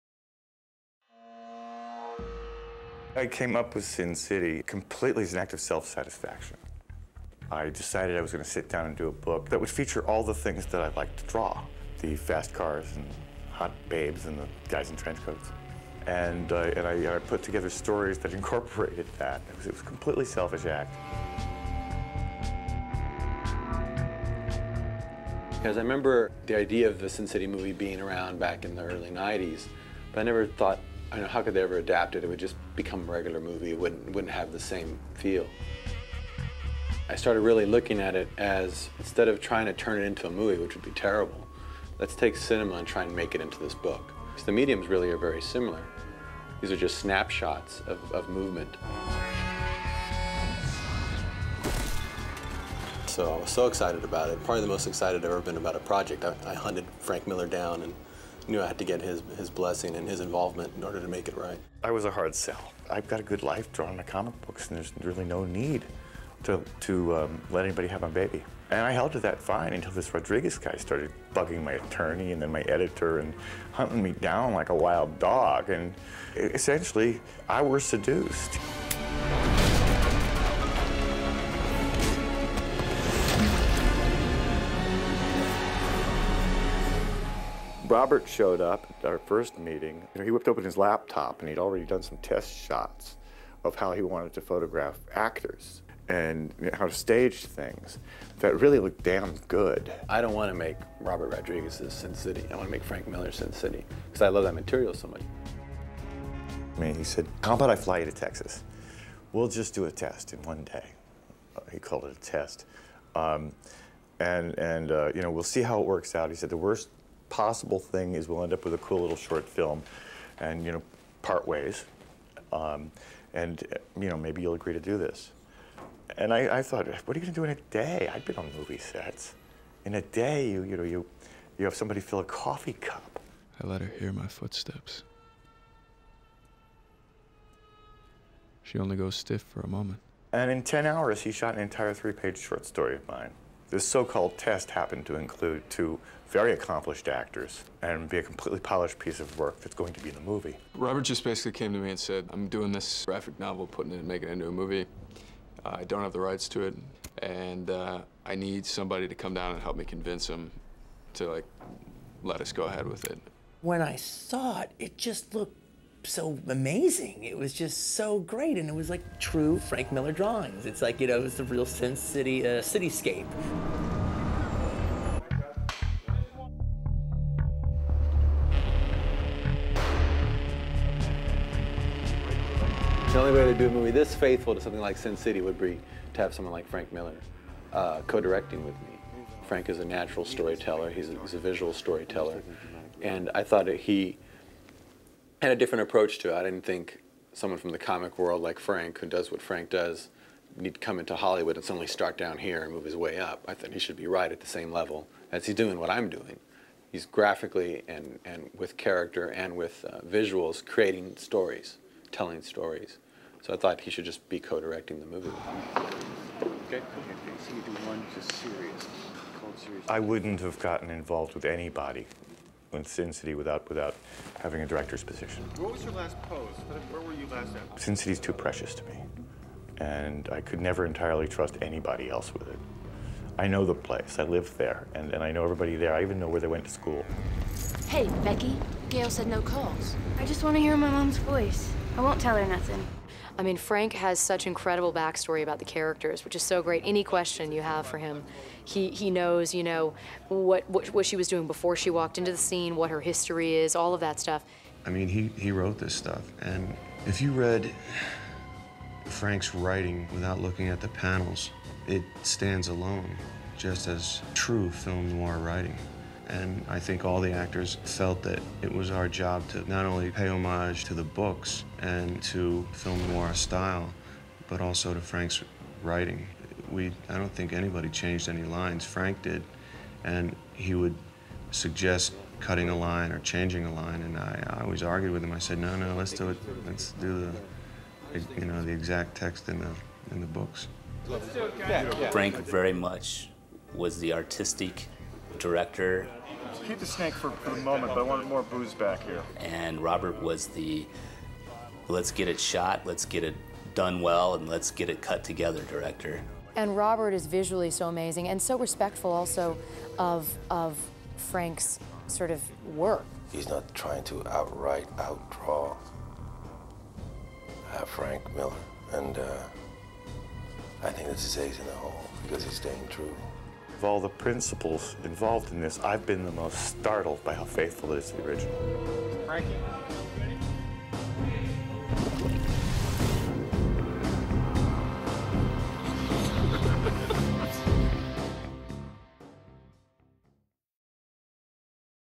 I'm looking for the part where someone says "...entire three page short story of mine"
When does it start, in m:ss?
2:21.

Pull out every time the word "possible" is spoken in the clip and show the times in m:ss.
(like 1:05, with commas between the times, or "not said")
1:57.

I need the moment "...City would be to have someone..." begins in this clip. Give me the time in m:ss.
3:05.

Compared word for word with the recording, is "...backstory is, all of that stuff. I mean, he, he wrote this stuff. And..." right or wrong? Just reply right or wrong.
wrong.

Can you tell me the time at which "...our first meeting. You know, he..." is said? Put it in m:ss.
1:29.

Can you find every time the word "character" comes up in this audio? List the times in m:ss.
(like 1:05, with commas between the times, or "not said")
3:28, 4:05.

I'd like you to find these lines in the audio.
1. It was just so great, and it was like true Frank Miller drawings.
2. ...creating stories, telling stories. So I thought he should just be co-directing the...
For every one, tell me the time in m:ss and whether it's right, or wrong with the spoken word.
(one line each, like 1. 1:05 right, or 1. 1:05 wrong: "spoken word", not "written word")
1. 2:47 right
2. 3:30 right.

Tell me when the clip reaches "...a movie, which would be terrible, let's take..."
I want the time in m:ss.
0:40.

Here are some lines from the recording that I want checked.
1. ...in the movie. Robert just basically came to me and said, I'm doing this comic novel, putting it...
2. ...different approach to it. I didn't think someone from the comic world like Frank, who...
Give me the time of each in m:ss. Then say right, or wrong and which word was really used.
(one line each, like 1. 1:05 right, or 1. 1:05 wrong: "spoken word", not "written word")
1. 2:30 wrong: "graphic", not "comic"
2. 3:15 right.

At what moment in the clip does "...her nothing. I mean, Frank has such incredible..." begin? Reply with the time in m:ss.
4:02.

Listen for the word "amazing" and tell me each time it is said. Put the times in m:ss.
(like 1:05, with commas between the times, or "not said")
2:46, 5:07.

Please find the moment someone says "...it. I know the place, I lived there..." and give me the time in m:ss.
3:52.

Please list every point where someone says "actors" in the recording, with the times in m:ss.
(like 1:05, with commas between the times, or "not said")
1:35, 2:27, 4:27.